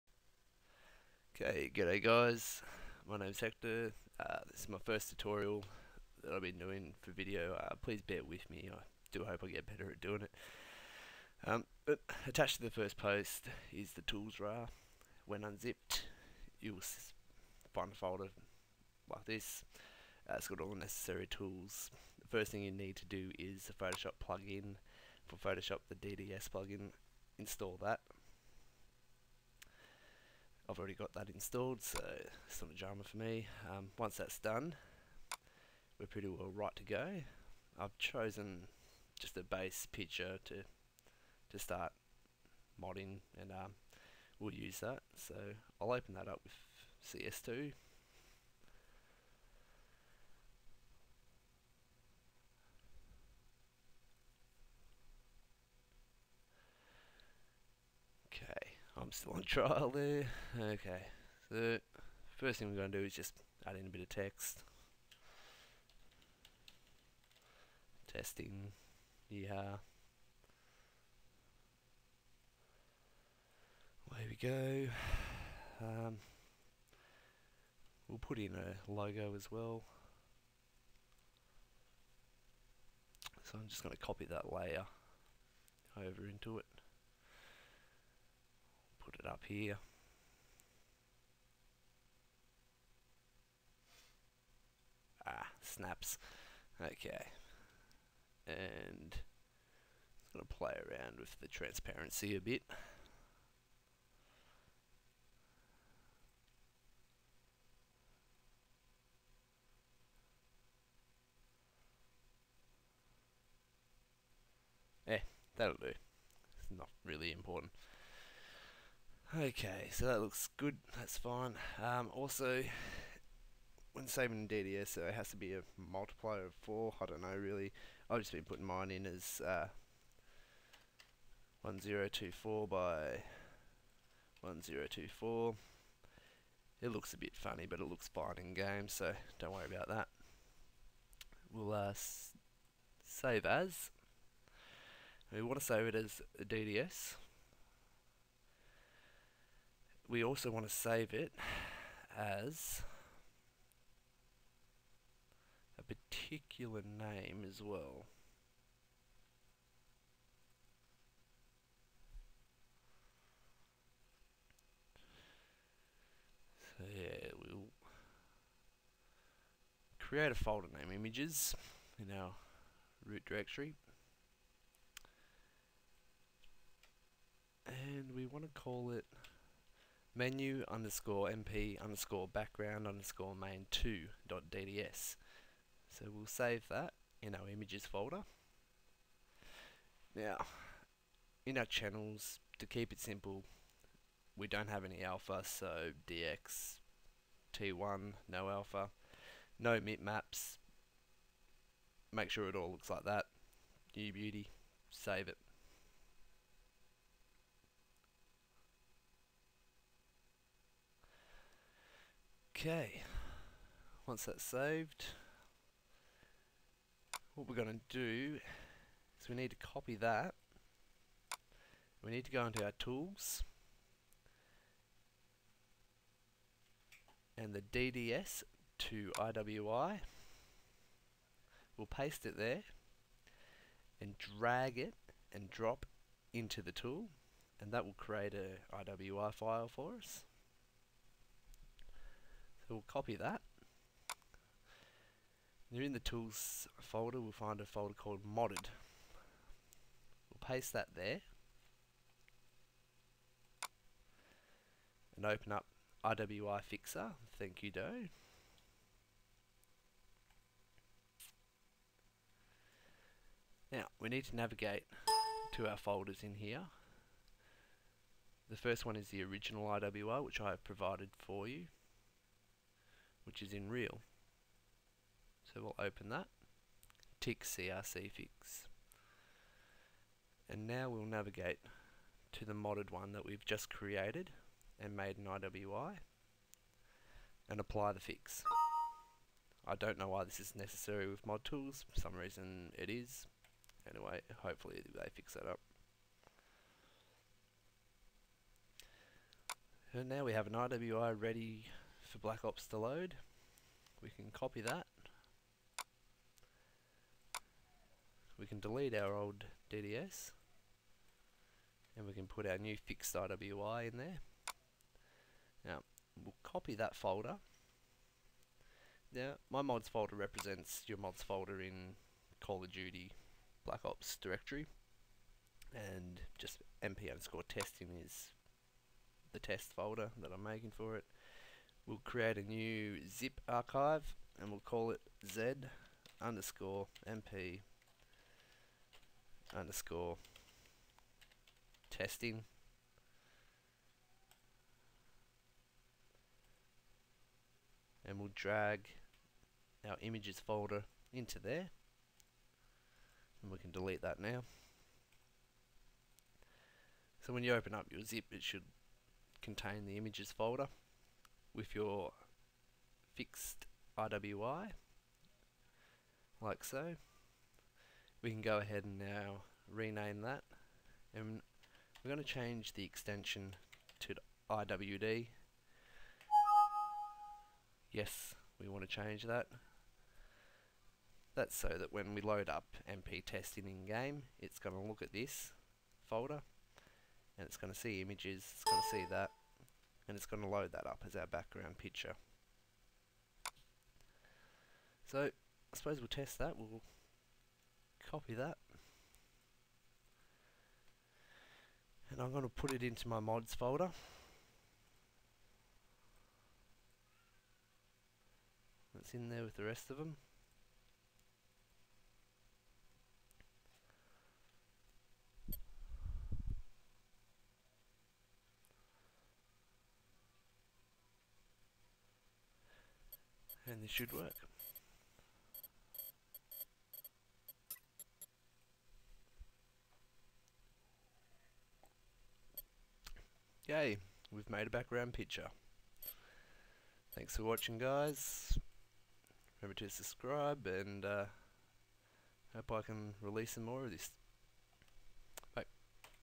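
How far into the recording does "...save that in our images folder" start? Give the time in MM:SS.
03:06.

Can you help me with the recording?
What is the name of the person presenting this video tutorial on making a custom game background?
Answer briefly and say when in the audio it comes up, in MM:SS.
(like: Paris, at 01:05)
Hector, at 00:03.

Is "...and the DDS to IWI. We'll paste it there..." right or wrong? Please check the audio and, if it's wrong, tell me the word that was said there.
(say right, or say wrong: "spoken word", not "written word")
right.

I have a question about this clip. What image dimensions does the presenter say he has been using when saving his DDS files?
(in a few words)
1024 by 1024.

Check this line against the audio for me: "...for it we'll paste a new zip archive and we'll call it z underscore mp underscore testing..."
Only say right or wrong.
wrong.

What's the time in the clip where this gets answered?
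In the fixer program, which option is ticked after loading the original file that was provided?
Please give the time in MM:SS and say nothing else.
04:37.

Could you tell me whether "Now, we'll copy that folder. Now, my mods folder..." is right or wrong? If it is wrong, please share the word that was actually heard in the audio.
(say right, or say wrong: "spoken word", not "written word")
right.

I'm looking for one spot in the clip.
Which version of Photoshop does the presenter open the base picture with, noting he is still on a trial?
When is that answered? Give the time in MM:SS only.
00:47.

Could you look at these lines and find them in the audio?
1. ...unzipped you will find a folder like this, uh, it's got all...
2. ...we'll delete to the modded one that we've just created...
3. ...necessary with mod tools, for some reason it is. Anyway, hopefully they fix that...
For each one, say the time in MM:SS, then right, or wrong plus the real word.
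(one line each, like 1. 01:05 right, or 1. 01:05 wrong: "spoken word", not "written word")
1. 00:15 right
2. 04:40 wrong: "navigate", not "delete"
3. 04:50 right.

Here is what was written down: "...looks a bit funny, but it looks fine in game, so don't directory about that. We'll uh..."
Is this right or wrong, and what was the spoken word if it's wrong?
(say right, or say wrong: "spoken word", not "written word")
wrong: "worry", not "directory".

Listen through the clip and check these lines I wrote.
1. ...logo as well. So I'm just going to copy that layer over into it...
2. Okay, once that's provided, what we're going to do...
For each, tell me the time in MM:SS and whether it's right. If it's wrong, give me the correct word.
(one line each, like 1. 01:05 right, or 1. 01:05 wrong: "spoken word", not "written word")
1. 01:18 right
2. 03:32 wrong: "saved", not "provided".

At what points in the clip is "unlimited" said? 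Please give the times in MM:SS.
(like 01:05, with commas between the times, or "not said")
not said.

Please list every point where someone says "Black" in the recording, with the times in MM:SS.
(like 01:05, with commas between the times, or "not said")
05:02, 05:23.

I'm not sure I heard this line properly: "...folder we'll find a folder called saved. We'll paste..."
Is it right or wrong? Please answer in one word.
wrong.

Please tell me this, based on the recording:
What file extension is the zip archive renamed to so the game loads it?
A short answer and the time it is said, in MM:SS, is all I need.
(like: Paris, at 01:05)
IWD, at 06:14.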